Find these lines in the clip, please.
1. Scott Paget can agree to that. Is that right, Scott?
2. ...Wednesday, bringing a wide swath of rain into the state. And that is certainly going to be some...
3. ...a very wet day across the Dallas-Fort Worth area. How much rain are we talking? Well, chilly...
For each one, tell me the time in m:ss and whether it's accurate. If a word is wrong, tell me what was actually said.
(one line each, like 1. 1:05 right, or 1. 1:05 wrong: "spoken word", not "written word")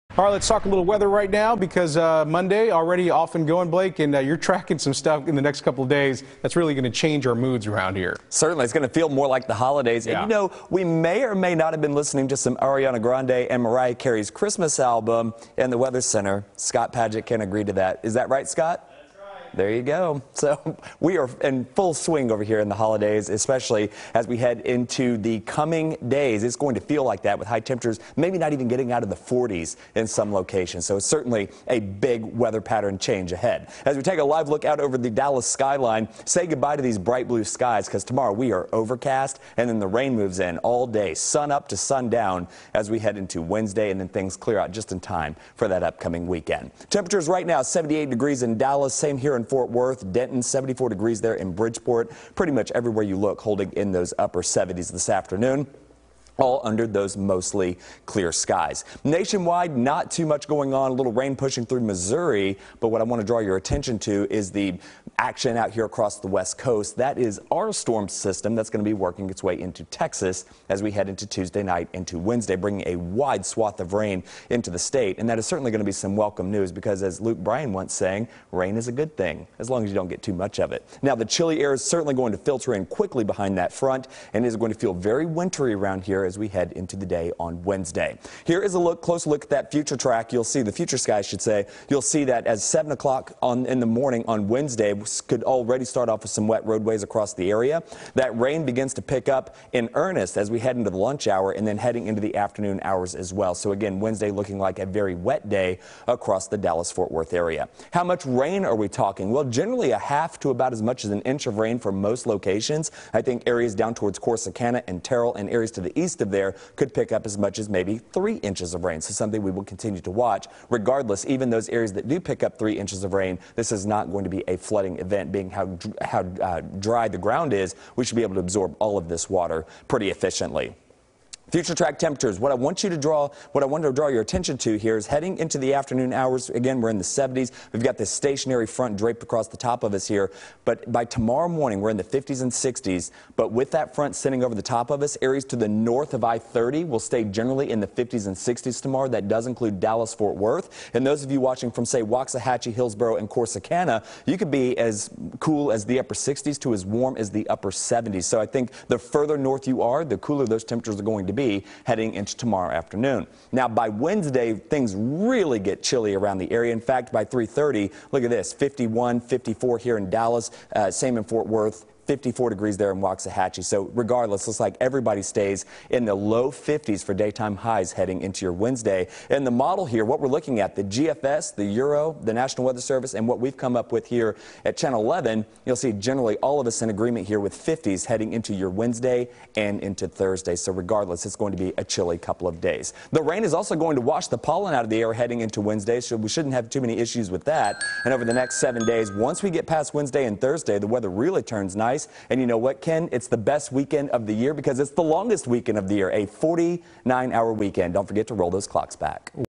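1. 0:16 right
2. 1:12 right
3. 1:44 wrong: "generally", not "chilly".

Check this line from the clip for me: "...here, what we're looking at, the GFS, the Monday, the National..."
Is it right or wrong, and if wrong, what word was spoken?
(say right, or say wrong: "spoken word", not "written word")
wrong: "Euro", not "Monday".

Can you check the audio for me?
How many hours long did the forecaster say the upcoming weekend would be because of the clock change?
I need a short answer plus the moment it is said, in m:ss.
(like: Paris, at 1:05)
49, at 3:26.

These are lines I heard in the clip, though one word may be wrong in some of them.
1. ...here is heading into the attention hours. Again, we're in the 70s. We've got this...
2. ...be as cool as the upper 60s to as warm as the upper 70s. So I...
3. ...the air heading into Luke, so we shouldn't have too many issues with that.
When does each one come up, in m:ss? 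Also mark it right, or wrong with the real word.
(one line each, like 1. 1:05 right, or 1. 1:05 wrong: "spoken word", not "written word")
1. 2:14 wrong: "afternoon", not "attention"
2. 2:34 right
3. 3:14 wrong: "Wednesday", not "Luke".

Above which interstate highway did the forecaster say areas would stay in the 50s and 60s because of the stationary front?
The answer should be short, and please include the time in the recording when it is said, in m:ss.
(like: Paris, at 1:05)
I-30, at 2:26.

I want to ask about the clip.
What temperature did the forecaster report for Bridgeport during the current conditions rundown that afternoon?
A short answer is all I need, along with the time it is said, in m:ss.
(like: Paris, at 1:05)
74 degrees, at 0:50.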